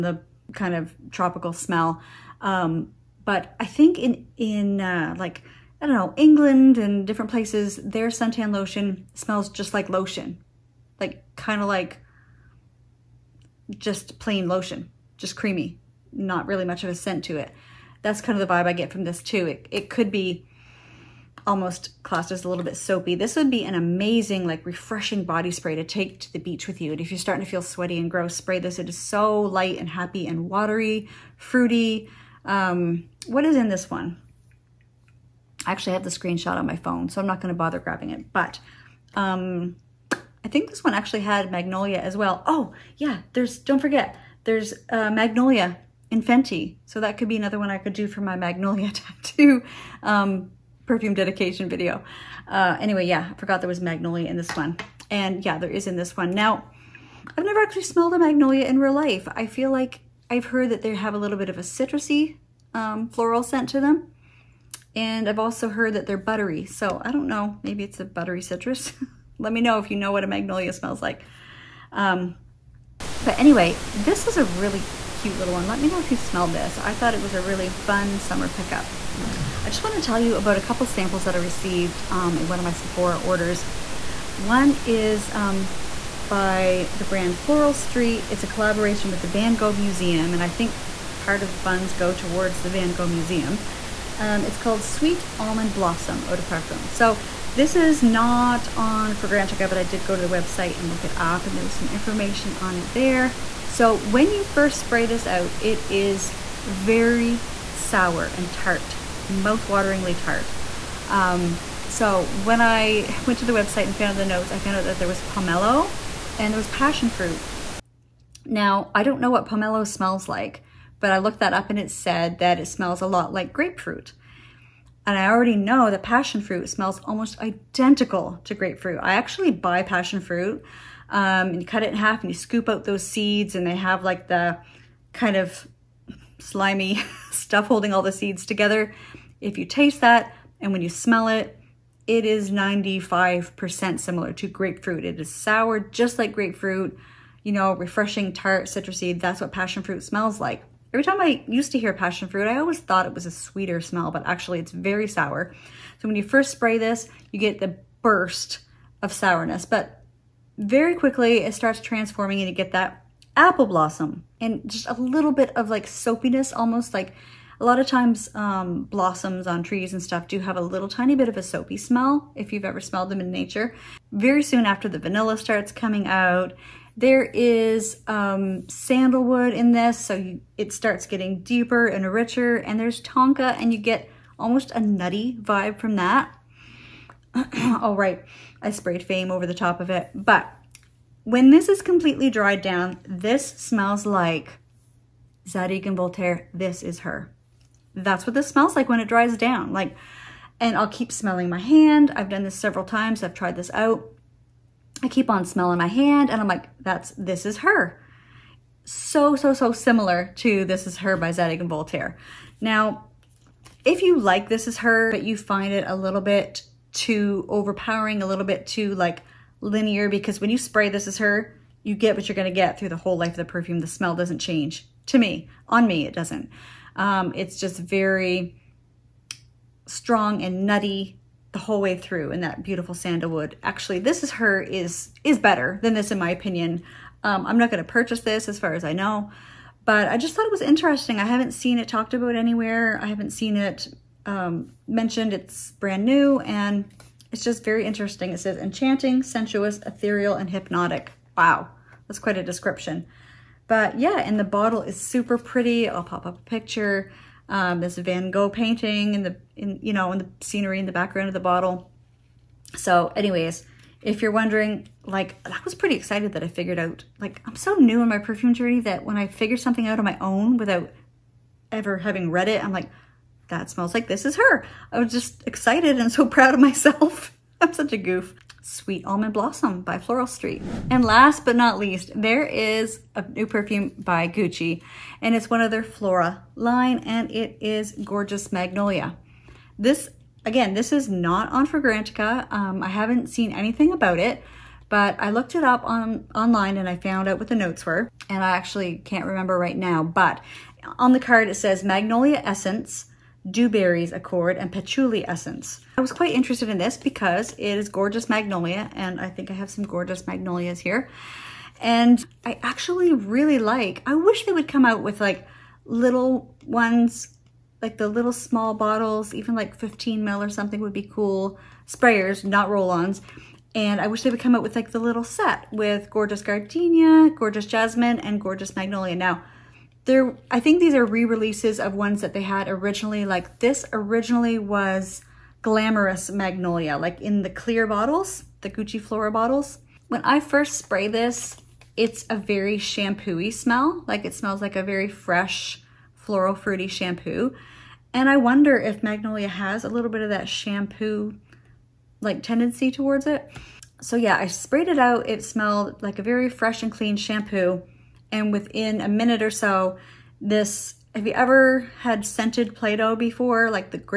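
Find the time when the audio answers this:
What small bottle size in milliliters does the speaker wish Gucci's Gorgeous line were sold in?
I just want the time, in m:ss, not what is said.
5:19.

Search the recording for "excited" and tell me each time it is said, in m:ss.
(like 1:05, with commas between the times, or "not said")
4:25, 4:35.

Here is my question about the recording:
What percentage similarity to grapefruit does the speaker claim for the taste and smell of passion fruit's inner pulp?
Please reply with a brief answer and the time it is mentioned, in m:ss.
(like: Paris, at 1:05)
95%, at 2:22.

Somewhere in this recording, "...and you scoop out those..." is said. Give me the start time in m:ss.
2:12.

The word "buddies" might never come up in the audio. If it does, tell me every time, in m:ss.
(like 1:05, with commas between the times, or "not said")
not said.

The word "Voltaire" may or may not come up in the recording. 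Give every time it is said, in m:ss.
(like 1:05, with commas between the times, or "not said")
3:15, 3:31.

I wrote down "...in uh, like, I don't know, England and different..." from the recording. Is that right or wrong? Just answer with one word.
right.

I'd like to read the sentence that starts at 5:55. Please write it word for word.
It smelled like a very fresh and clean shampoo.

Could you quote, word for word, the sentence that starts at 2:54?
Very soon after the vanilla starts coming out there is um, sandalwood in this, so you, it starts getting deeper and richer.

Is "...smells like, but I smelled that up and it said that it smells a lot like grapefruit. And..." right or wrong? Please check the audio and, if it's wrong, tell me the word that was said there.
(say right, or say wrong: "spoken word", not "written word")
wrong: "looked", not "smelled".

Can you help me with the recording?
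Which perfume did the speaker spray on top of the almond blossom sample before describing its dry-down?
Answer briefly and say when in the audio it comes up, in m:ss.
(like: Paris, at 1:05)
Fame, at 3:09.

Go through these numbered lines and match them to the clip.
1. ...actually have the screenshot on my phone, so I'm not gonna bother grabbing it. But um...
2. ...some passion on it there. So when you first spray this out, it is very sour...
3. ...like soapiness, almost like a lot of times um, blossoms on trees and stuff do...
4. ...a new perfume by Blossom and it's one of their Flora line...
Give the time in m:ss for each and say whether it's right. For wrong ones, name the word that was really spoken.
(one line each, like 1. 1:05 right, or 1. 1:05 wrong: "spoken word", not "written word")
1. 0:35 right
2. 1:41 wrong: "information", not "passion"
3. 2:45 right
4. 4:43 wrong: "Gucci", not "Blossom".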